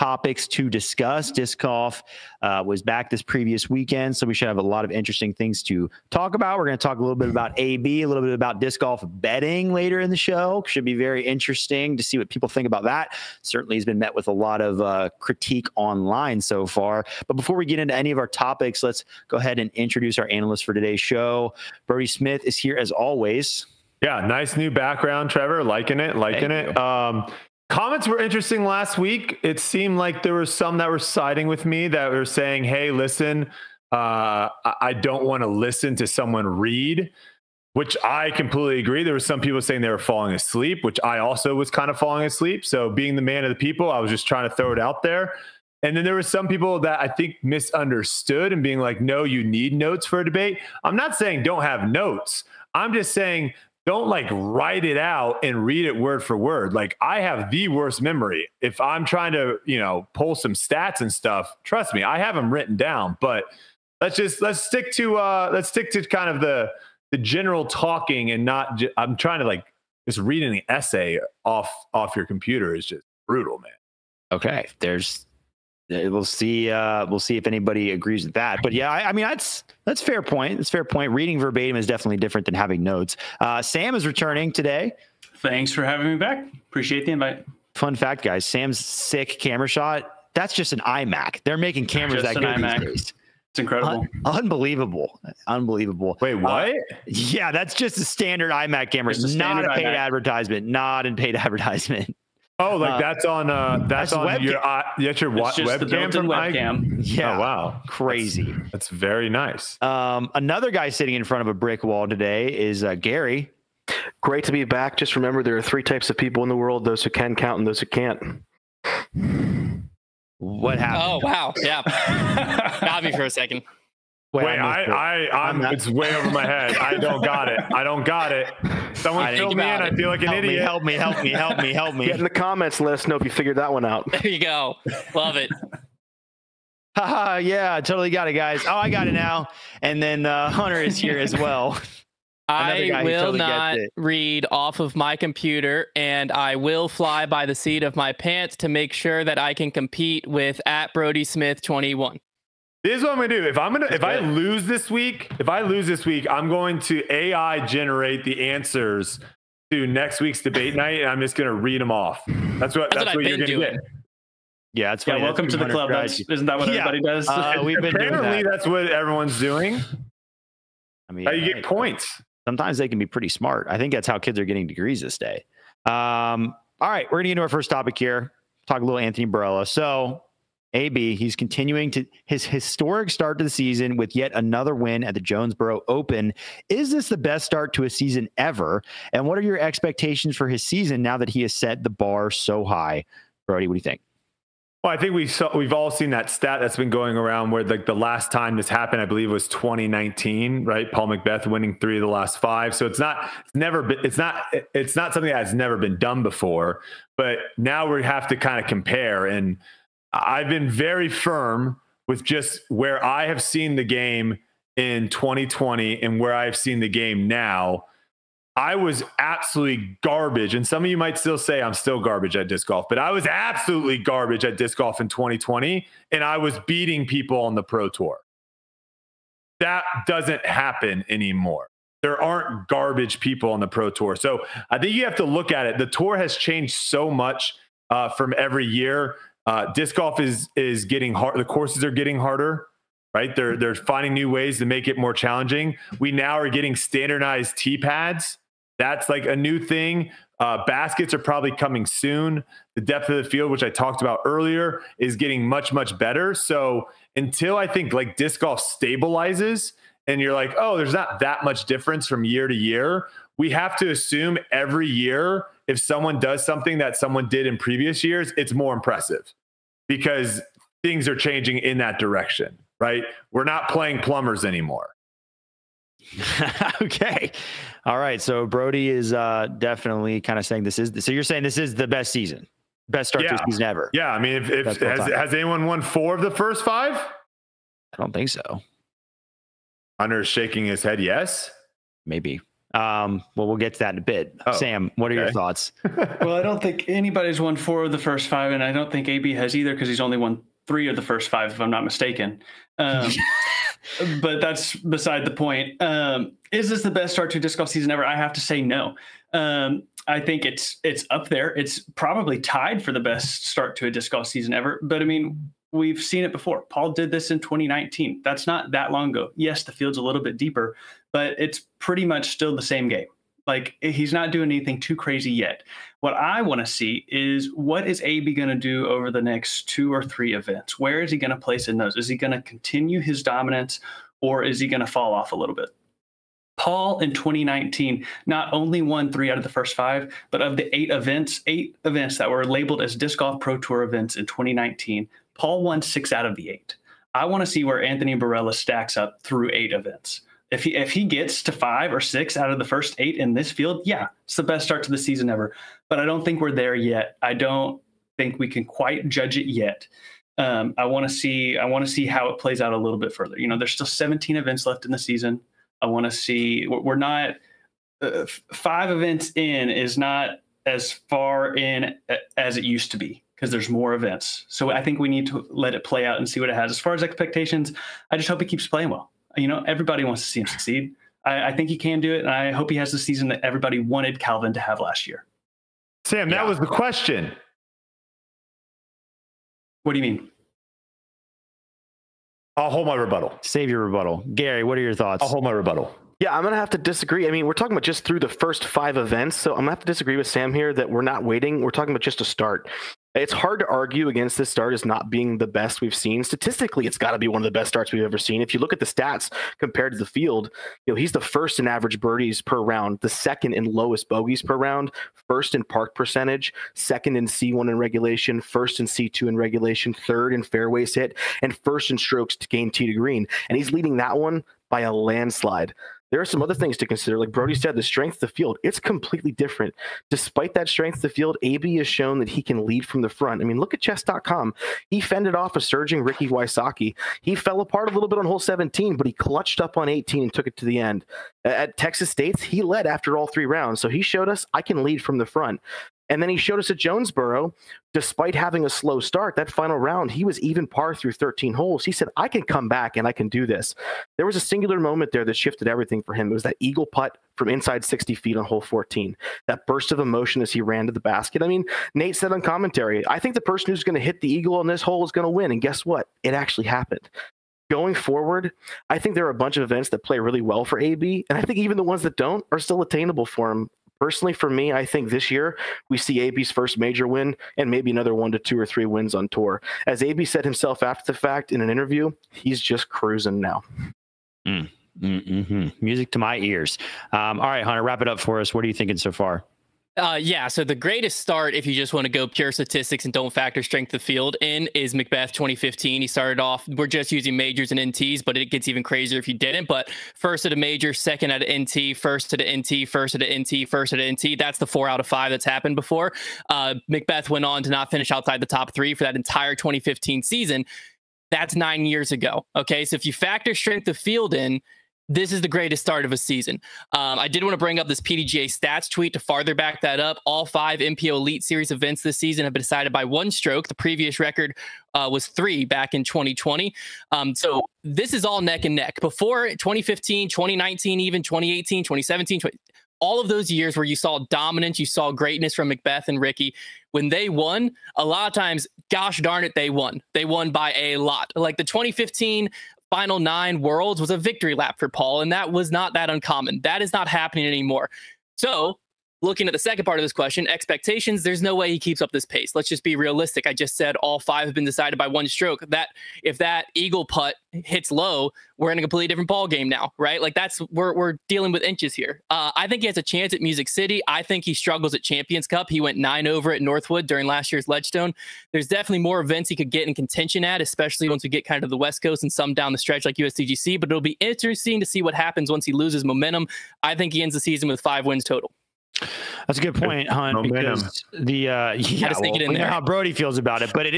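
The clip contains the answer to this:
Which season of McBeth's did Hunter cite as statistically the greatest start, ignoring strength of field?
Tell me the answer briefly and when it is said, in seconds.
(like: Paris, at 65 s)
2015, at 494 s.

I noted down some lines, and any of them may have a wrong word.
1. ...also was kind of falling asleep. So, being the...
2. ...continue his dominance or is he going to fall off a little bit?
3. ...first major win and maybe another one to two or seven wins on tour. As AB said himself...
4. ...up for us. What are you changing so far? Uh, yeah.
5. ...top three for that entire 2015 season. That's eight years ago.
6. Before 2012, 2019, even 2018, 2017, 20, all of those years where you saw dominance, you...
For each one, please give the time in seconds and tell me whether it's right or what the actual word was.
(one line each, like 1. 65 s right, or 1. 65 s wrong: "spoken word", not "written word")
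1. 41 s right
2. 332 s right
3. 476 s wrong: "three", not "seven"
4. 488 s wrong: "thinking", not "changing"
5. 508 s wrong: "nine", not "eight"
6. 528 s wrong: "2015", not "2012".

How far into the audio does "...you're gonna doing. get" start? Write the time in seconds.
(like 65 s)
163 s.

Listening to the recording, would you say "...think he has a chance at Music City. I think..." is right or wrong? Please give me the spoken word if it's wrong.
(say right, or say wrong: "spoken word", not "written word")
right.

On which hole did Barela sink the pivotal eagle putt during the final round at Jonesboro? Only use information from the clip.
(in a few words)
hole 14.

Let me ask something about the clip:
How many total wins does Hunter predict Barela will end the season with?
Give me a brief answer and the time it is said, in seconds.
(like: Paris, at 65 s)
5, at 577 s.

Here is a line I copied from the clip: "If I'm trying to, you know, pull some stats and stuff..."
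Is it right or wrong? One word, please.
right.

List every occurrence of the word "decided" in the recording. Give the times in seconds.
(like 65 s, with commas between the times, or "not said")
522 s, 554 s.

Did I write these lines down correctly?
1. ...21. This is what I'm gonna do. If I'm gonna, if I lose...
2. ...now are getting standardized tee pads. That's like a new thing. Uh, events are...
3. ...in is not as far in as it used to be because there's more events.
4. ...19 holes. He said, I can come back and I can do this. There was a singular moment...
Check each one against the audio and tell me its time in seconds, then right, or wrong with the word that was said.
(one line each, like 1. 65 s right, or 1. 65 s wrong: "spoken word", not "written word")
1. 151 s right
2. 246 s wrong: "baskets", not "events"
3. 369 s right
4. 451 s wrong: "13", not "19".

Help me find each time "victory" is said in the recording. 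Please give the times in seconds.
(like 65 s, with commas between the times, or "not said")
544 s.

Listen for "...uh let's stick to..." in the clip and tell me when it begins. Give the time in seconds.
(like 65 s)
65 s.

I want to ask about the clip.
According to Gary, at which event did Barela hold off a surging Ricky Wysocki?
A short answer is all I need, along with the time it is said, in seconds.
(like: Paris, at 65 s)
chess.com, at 433 s.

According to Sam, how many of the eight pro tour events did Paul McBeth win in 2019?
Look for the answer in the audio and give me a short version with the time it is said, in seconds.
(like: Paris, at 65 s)
6, at 345 s.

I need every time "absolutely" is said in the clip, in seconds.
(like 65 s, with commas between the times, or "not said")
219 s, 223 s.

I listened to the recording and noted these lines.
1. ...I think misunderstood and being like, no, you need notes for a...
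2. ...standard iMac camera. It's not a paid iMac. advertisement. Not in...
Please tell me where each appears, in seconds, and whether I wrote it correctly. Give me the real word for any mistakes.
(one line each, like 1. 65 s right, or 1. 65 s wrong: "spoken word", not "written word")
1. 46 s right
2. 98 s right.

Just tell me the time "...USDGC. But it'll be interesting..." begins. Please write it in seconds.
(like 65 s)
573 s.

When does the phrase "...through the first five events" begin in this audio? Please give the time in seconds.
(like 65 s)
398 s.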